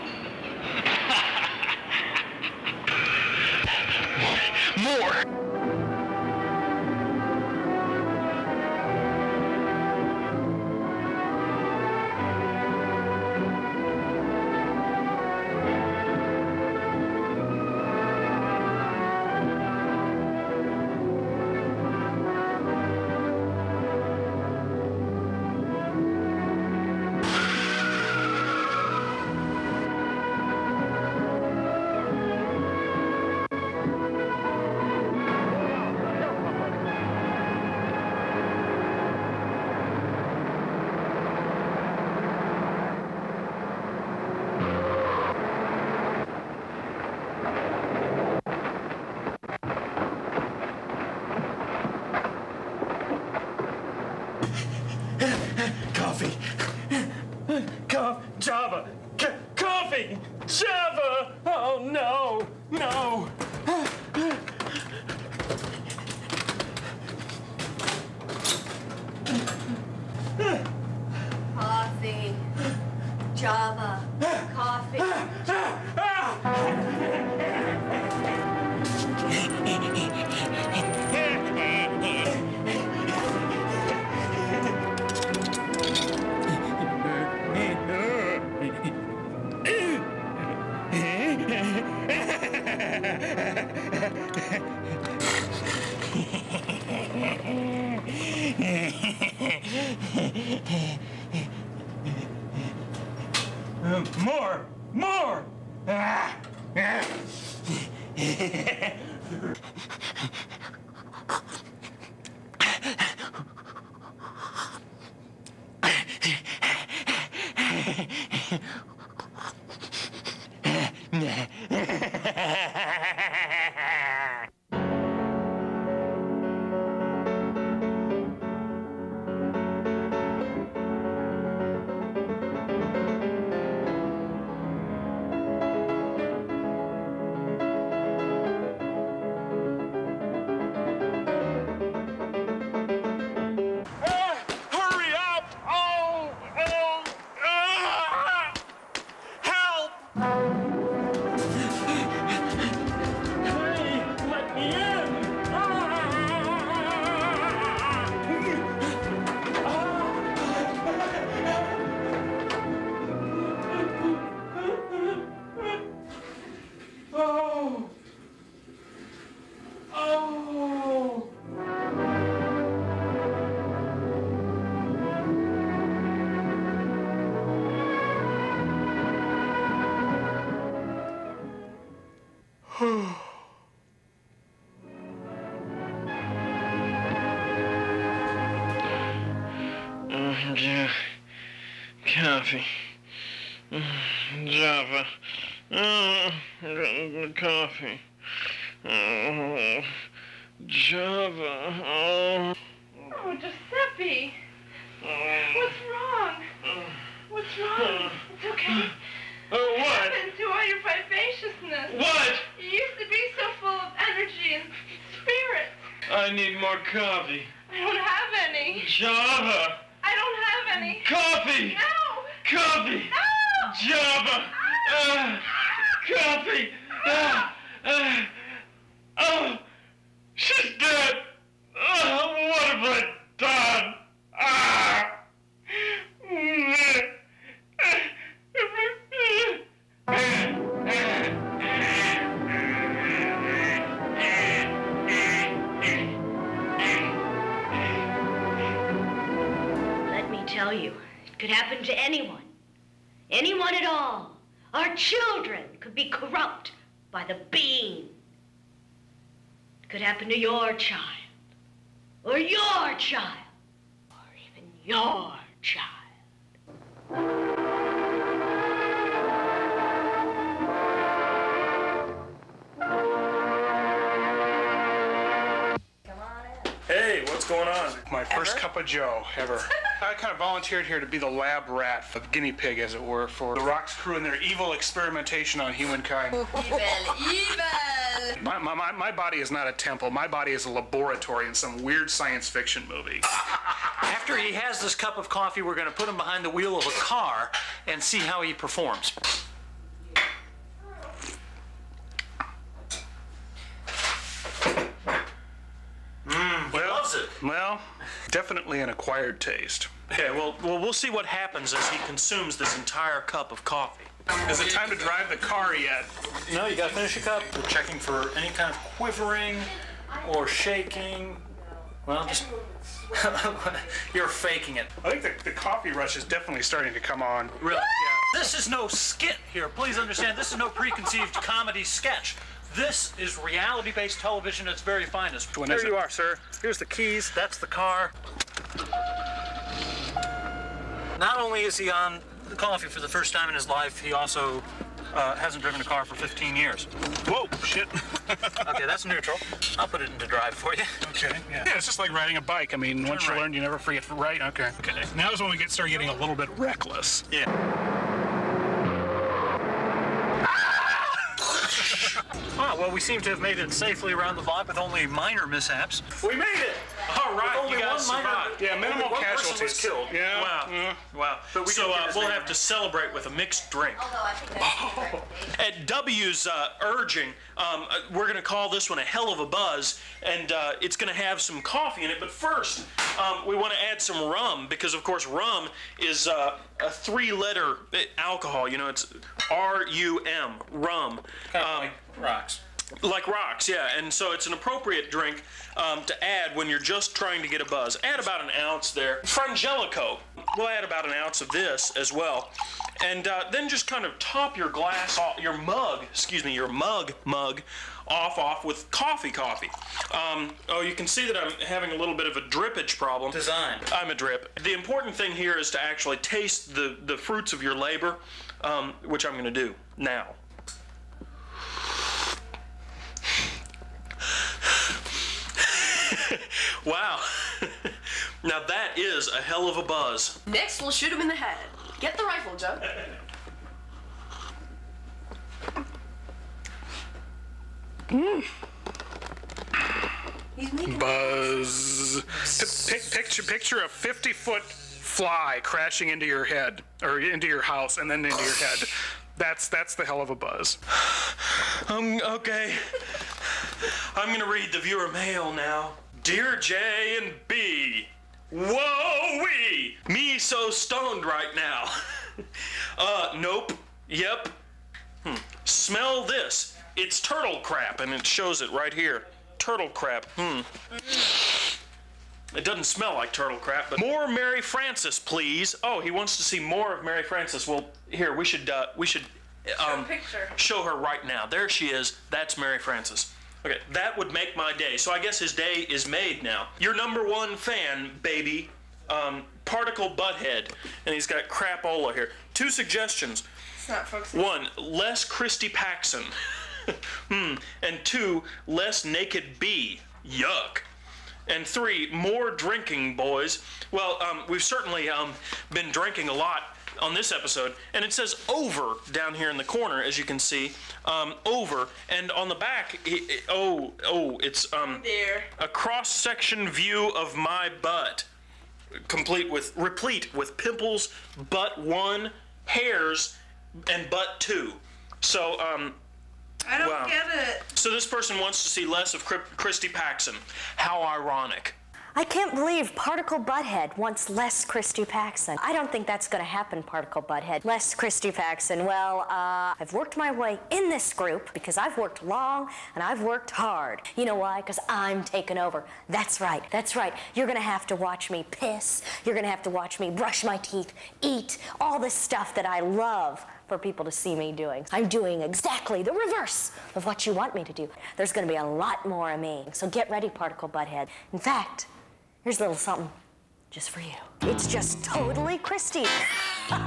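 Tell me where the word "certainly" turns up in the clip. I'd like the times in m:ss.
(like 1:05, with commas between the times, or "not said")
8:24.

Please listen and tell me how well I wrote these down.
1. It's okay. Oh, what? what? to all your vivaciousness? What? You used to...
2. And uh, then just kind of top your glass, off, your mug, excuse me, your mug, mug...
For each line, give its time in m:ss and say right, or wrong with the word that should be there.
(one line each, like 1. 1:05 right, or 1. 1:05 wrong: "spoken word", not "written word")
1. 3:28 right
2. 6:43 right.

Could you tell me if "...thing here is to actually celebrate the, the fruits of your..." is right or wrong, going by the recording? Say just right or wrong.
wrong.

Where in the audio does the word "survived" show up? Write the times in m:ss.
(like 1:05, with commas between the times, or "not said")
6:08.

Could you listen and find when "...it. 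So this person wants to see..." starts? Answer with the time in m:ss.
8:47.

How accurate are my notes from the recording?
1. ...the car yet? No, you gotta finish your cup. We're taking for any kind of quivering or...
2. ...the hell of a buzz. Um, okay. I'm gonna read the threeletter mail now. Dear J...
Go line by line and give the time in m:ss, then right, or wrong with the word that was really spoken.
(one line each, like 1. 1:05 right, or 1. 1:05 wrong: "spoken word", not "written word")
1. 5:15 wrong: "checking", not "taking"
2. 7:29 wrong: "viewer", not "threeletter".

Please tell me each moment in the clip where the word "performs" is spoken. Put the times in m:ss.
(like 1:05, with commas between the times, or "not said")
4:58.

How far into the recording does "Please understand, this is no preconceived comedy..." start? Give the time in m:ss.
5:29.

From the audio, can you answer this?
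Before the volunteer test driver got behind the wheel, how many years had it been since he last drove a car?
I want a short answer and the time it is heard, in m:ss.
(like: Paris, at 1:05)
15, at 5:46.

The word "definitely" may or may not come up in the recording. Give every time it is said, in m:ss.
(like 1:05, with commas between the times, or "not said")
5:08, 5:26.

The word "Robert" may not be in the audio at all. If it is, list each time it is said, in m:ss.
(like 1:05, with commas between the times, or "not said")
not said.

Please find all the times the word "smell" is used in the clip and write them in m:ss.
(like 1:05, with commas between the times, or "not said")
7:45, 7:52.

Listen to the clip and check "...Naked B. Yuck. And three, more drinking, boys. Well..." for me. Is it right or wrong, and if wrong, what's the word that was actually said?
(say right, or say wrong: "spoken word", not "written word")
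right.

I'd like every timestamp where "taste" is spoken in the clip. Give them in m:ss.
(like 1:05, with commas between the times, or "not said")
5:09, 6:56.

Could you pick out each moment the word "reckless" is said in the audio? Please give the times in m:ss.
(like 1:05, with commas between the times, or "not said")
5:56.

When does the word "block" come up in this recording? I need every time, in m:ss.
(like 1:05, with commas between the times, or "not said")
6:04.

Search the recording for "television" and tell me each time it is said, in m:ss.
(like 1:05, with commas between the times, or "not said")
5:34.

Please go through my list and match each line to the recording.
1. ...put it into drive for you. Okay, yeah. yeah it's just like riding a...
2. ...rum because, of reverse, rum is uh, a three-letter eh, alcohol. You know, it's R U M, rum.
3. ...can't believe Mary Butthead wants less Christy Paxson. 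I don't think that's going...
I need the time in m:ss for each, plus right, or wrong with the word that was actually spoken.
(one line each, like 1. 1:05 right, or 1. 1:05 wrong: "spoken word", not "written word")
1. 5:49 right
2. 6:24 wrong: "course", not "reverse"
3. 8:52 wrong: "Particle", not "Mary".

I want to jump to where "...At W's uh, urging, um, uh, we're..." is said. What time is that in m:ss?
6:15.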